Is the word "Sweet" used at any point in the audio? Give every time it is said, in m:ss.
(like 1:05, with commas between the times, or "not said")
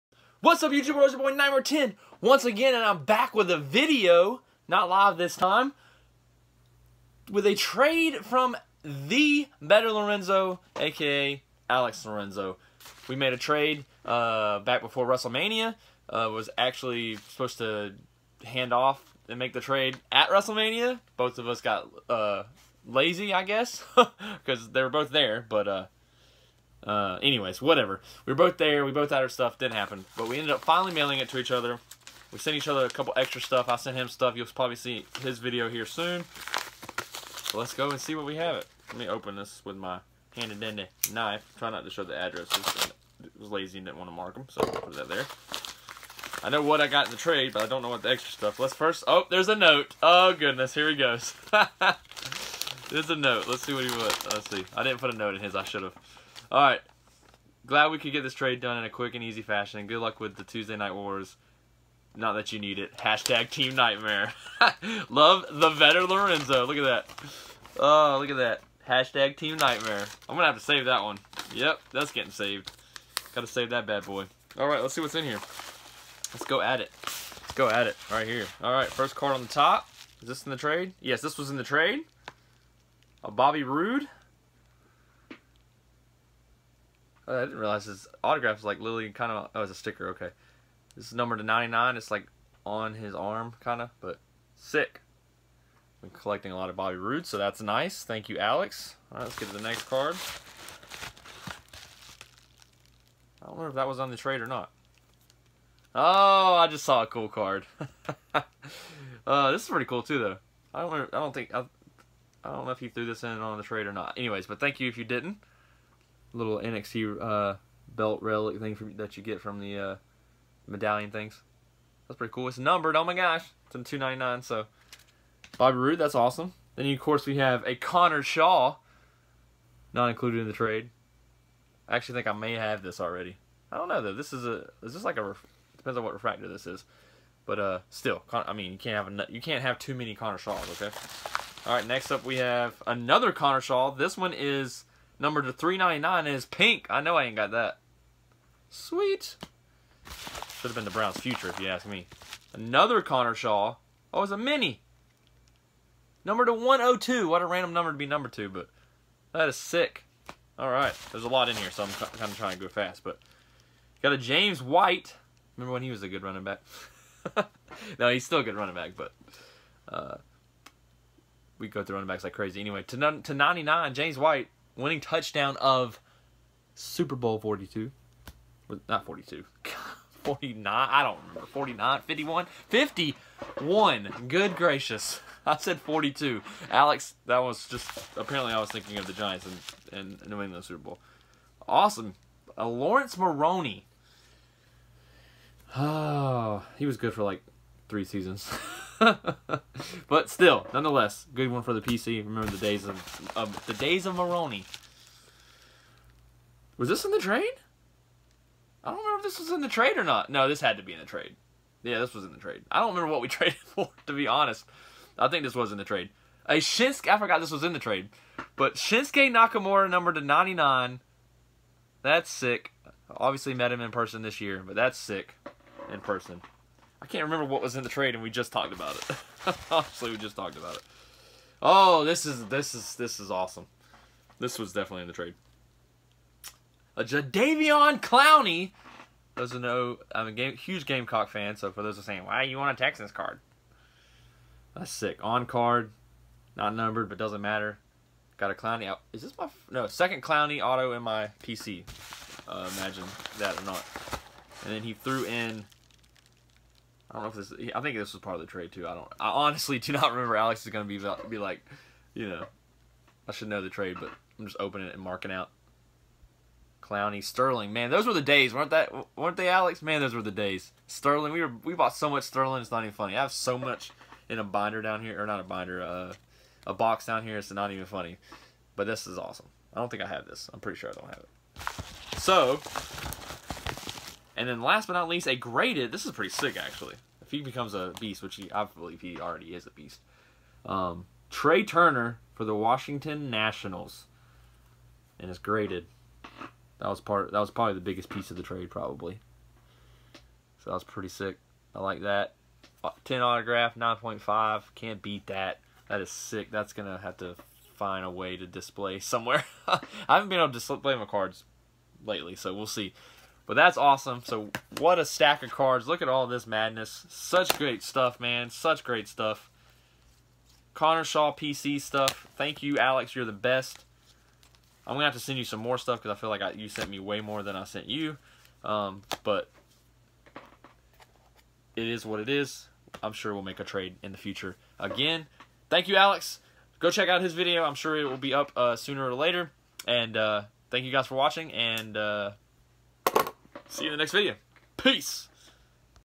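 2:28.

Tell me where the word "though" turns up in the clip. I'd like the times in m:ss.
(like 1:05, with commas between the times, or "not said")
1:50, 2:14.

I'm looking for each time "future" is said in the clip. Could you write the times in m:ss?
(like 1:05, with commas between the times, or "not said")
2:31, 5:34.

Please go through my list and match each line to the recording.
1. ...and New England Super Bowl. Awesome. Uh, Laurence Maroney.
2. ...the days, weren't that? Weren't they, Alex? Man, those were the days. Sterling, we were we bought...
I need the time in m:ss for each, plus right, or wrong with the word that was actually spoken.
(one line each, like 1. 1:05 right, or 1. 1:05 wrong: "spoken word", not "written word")
1. 3:10 right
2. 4:28 right.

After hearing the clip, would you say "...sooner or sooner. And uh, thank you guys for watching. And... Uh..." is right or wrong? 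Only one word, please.
wrong.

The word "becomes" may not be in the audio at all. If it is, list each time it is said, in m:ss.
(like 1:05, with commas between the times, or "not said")
4:47.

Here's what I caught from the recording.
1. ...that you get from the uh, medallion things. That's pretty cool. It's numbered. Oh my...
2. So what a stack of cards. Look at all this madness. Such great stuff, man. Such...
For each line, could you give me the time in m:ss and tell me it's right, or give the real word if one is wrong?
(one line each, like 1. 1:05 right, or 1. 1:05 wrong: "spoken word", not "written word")
1. 1:58 right
2. 5:14 right.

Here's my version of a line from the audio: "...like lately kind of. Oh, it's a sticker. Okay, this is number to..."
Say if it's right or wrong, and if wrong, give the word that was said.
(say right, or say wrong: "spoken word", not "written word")
wrong: "literally", not "lately".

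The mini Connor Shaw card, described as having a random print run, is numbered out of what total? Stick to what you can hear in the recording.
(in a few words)
102.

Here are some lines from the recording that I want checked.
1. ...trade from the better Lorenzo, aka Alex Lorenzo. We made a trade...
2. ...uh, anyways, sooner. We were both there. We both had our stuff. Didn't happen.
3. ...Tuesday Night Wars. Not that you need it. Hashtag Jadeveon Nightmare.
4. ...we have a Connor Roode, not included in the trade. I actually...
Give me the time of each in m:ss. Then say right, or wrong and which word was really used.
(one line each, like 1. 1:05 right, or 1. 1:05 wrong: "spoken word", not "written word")
1. 0:07 right
2. 0:26 wrong: "whatever", not "sooner"
3. 1:00 wrong: "Team", not "Jadeveon"
4. 2:07 wrong: "Shaw", not "Roode".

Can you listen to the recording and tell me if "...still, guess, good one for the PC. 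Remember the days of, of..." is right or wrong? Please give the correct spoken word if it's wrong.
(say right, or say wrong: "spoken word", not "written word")
wrong: "nonetheless", not "guess".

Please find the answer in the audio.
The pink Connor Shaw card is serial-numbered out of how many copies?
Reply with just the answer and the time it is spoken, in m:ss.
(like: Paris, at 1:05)
399, at 2:25.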